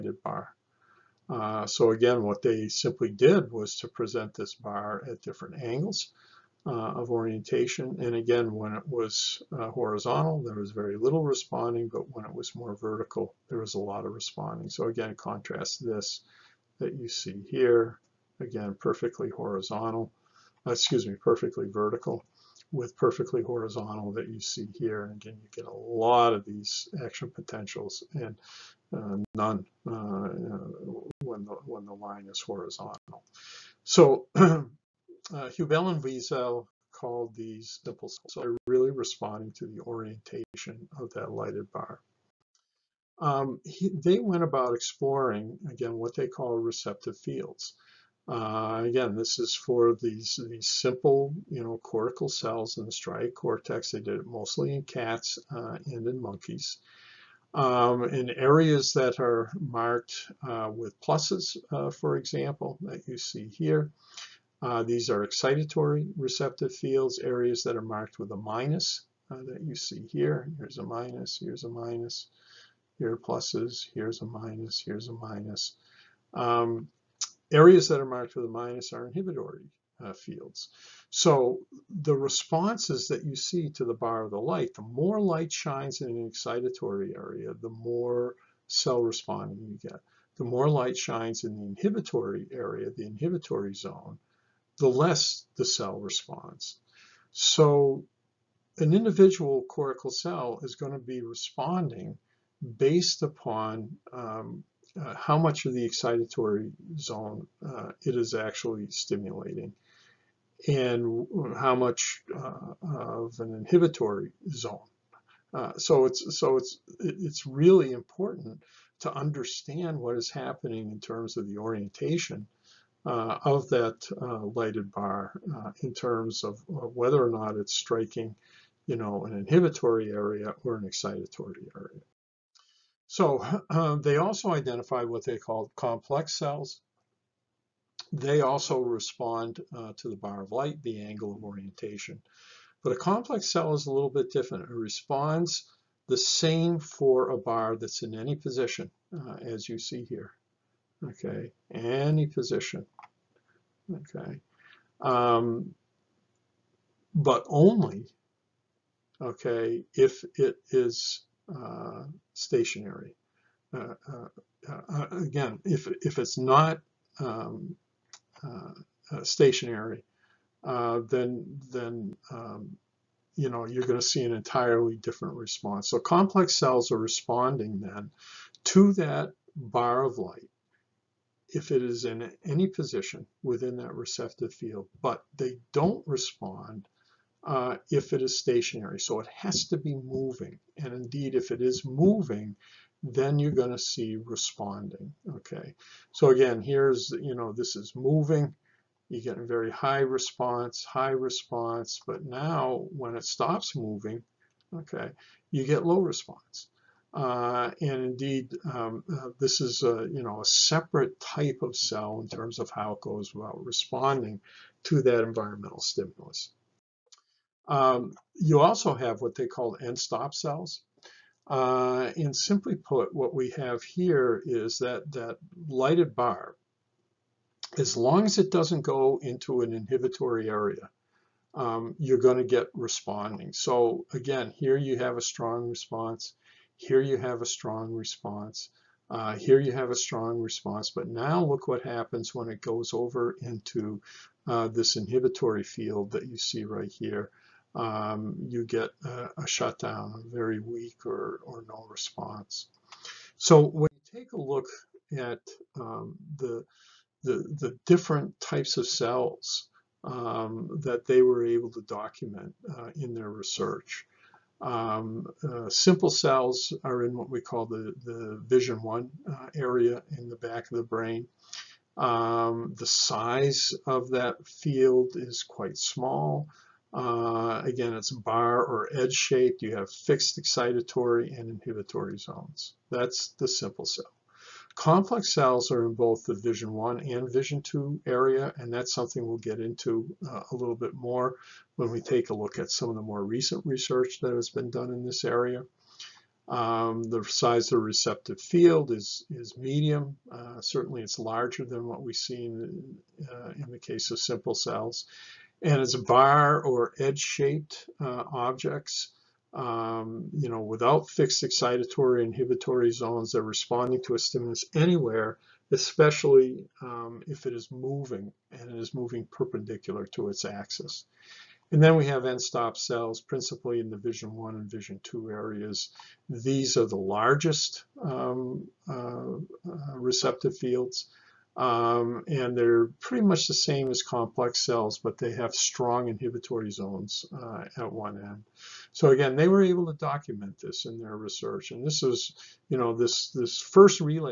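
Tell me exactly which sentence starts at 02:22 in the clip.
But a complex cell is a little bit different.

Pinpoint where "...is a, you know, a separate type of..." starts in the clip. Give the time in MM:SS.
03:29.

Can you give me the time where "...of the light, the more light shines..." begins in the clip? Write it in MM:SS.
01:24.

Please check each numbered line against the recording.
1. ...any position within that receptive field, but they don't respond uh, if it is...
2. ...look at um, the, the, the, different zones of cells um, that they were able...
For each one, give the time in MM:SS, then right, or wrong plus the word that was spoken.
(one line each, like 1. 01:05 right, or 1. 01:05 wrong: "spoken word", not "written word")
1. 03:02 right
2. 04:14 wrong: "types", not "zones".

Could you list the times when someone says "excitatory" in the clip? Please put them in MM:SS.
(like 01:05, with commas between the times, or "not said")
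01:05, 01:26, 01:45, 02:10, 04:40, 05:11.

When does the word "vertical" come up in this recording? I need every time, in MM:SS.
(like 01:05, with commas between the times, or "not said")
00:12, 00:21.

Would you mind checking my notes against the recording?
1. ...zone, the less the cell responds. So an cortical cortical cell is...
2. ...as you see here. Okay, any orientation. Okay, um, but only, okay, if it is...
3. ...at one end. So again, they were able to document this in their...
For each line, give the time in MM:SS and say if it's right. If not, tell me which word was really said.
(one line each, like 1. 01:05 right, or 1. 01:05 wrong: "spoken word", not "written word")
1. 01:33 wrong: "individual", not "cortical"
2. 02:29 wrong: "position", not "orientation"
3. 05:37 right.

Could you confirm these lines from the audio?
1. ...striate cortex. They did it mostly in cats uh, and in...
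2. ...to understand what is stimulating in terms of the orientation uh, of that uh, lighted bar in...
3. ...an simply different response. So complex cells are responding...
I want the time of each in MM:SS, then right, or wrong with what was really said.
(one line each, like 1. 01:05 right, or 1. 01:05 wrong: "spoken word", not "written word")
1. 00:52 right
2. 01:58 wrong: "happening", not "stimulating"
3. 02:54 wrong: "entirely", not "simply".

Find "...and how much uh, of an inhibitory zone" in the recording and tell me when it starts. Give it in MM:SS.
01:50.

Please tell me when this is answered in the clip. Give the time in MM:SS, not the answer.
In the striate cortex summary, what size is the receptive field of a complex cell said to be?
04:59.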